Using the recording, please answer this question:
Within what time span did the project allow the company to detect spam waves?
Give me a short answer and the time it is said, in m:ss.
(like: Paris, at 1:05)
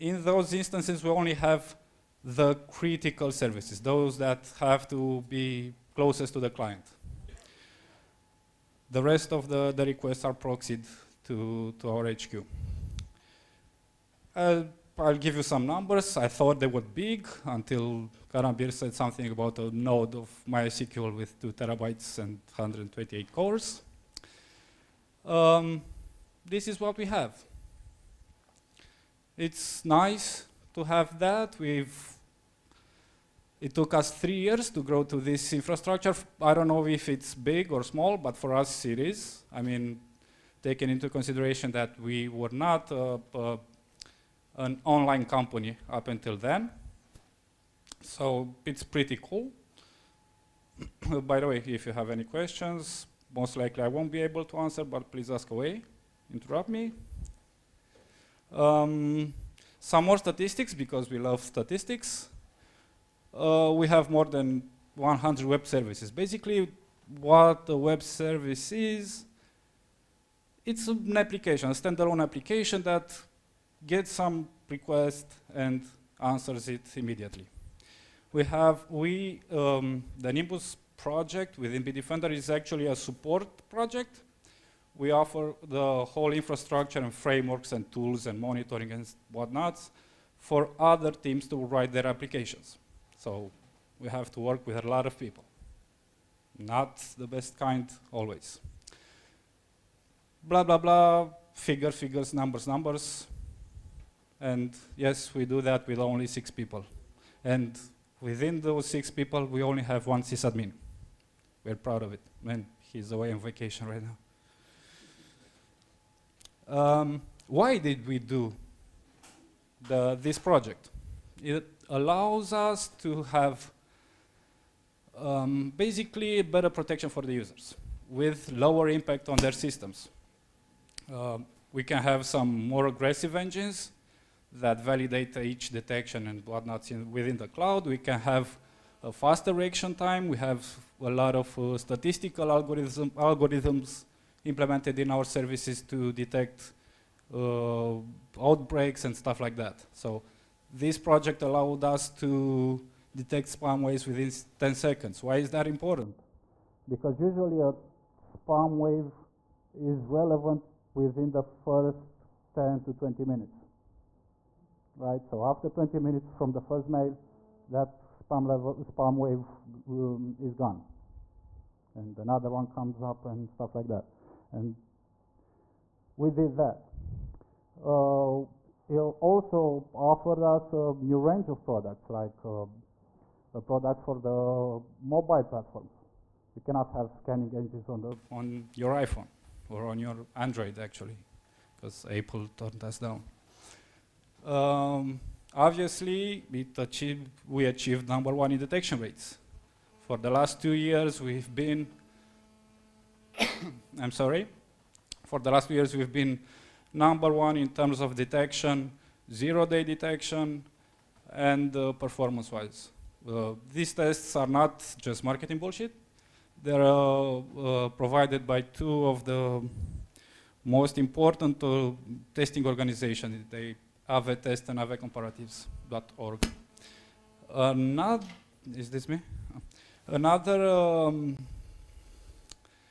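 10 seconds, at 2:34.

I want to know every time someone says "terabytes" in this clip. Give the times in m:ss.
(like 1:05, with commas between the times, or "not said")
0:21.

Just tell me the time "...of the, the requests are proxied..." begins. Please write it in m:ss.
0:09.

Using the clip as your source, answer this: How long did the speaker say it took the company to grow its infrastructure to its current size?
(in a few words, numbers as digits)
3 years.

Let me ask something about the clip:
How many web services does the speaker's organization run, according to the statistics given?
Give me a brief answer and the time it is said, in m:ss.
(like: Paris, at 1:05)
more than 100, at 1:04.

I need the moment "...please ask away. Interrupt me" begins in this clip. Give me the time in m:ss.
0:55.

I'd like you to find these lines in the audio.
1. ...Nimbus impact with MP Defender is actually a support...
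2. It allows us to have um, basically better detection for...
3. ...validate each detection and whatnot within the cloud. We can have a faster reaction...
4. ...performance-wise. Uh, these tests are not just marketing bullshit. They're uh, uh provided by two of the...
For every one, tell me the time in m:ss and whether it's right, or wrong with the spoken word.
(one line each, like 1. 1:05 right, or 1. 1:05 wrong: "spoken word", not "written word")
1. 1:20 wrong: "project", not "impact"
2. 2:01 wrong: "protection", not "detection"
3. 2:14 right
4. 3:31 right.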